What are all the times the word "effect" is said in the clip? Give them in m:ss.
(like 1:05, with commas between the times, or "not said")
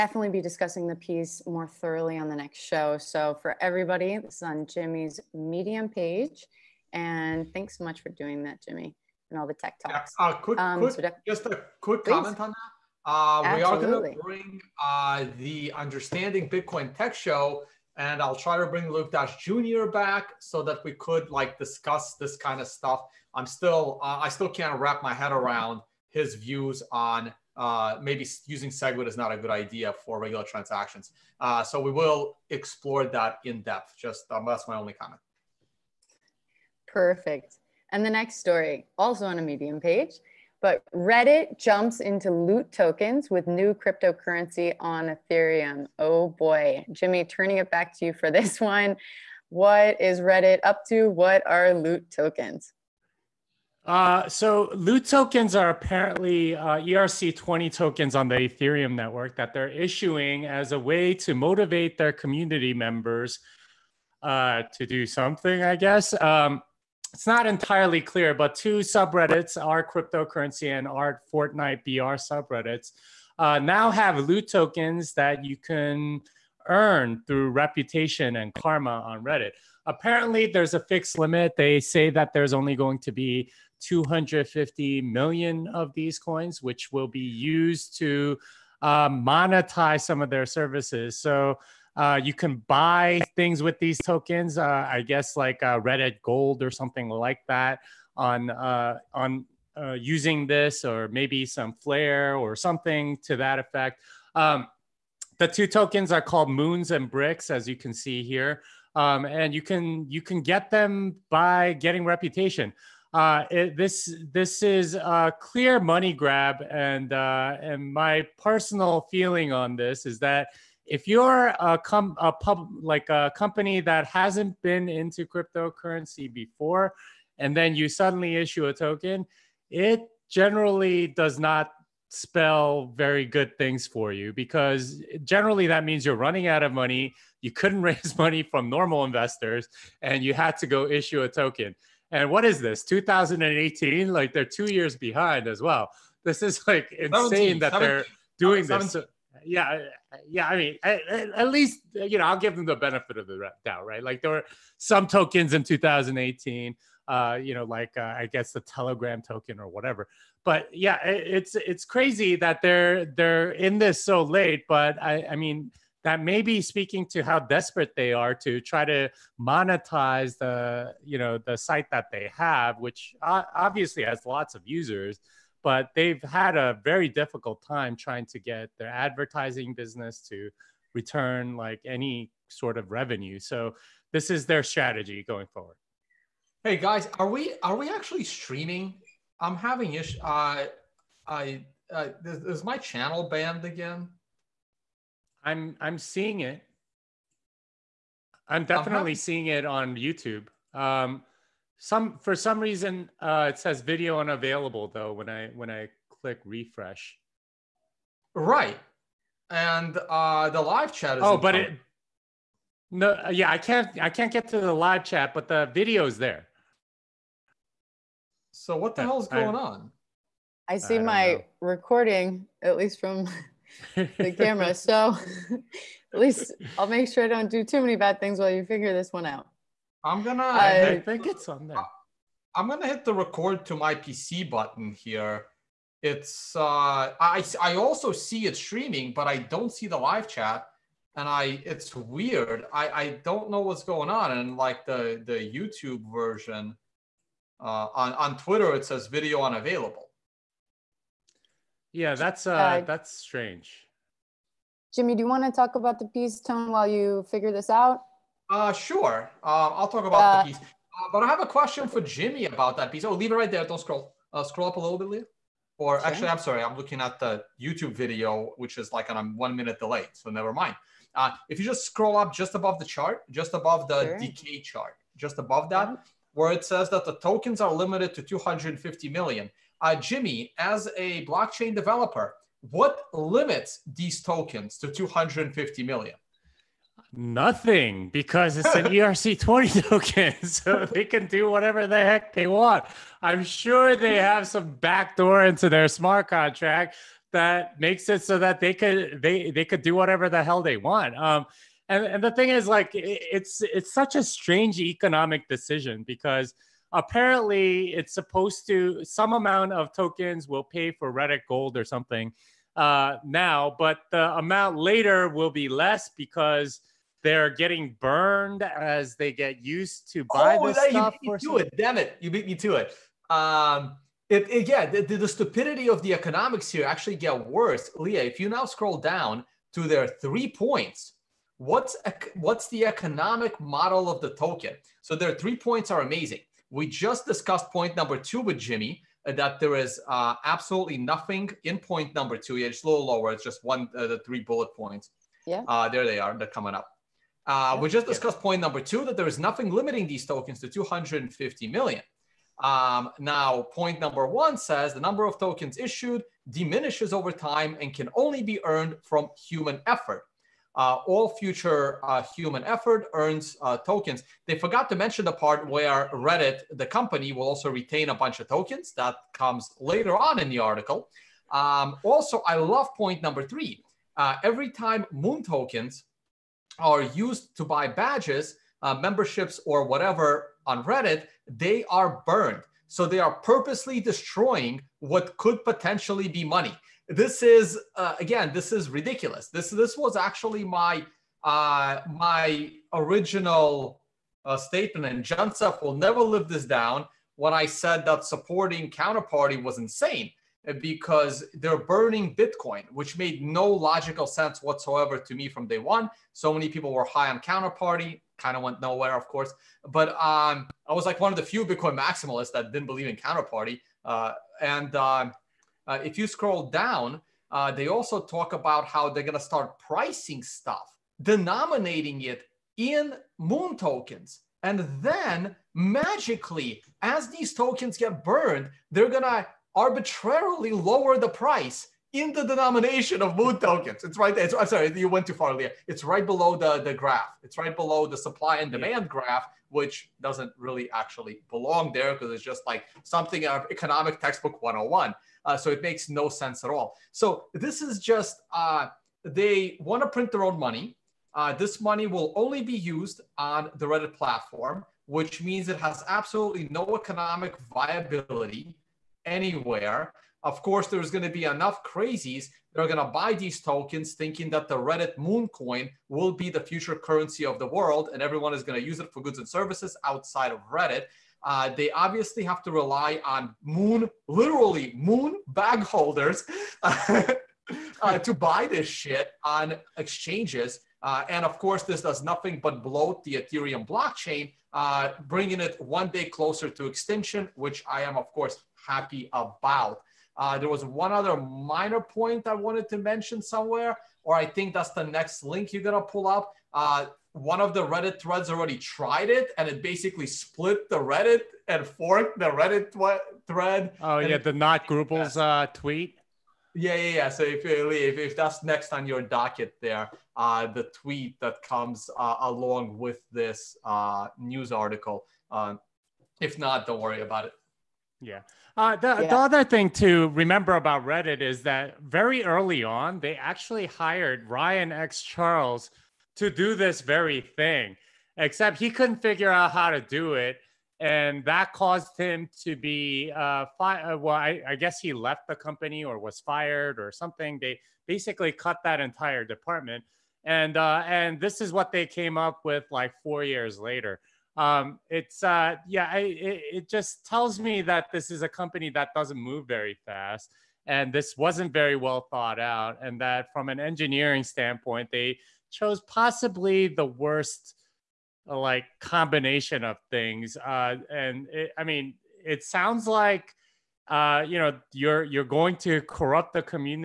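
1:43.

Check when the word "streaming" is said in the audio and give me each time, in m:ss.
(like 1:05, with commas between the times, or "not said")
3:08, 3:58.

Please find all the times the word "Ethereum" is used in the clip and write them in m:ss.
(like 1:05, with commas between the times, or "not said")
0:45, 0:58, 8:03.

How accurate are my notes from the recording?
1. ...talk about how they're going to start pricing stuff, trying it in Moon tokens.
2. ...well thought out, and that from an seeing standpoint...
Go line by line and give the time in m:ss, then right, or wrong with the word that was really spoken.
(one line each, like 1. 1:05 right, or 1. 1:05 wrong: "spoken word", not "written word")
1. 6:58 wrong: "denominating", not "trying"
2. 9:11 wrong: "engineering", not "seeing".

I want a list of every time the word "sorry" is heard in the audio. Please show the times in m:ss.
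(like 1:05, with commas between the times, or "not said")
4:26, 7:14.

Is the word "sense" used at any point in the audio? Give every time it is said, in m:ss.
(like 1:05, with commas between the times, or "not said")
6:44, 7:26.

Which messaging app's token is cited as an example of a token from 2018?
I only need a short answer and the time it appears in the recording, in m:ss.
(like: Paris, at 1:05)
Telegram, at 2:38.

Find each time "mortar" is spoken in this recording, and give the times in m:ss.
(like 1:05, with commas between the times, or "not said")
not said.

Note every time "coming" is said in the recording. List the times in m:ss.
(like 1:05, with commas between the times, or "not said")
5:46.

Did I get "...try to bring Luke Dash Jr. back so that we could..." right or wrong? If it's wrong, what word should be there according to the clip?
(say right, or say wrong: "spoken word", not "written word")
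right.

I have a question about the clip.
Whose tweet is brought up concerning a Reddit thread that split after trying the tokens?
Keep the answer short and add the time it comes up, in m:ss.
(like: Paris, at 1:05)
not Grubles, at 8:24.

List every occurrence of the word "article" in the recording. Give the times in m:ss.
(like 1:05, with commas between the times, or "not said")
6:10, 8:34.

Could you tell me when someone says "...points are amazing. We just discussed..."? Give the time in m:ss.
5:35.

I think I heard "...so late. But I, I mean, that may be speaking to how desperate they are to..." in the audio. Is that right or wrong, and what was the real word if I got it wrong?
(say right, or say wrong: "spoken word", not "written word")
right.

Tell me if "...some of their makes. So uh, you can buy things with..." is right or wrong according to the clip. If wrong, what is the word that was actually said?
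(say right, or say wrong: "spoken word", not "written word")
wrong: "services", not "makes".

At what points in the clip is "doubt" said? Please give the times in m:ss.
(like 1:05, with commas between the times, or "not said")
2:33.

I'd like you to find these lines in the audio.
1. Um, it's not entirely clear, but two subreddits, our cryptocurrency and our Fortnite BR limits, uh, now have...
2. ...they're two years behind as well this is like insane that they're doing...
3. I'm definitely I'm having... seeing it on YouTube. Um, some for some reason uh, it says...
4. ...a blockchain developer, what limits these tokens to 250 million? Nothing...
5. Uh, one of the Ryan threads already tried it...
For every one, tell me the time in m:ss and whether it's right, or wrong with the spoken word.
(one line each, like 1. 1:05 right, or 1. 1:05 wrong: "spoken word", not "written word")
1. 1:06 wrong: "subreddits", not "limits"
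2. 2:24 right
3. 3:18 right
4. 4:40 right
5. 8:16 wrong: "Reddit", not "Ryan".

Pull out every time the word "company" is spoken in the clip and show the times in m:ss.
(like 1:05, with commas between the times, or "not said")
2:03, 6:06, 8:55, 9:08.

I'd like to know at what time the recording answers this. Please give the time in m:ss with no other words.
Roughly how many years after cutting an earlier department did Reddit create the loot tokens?
9:03.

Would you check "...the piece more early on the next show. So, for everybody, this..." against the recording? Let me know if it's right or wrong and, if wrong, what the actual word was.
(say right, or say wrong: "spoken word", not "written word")
wrong: "thoroughly", not "early".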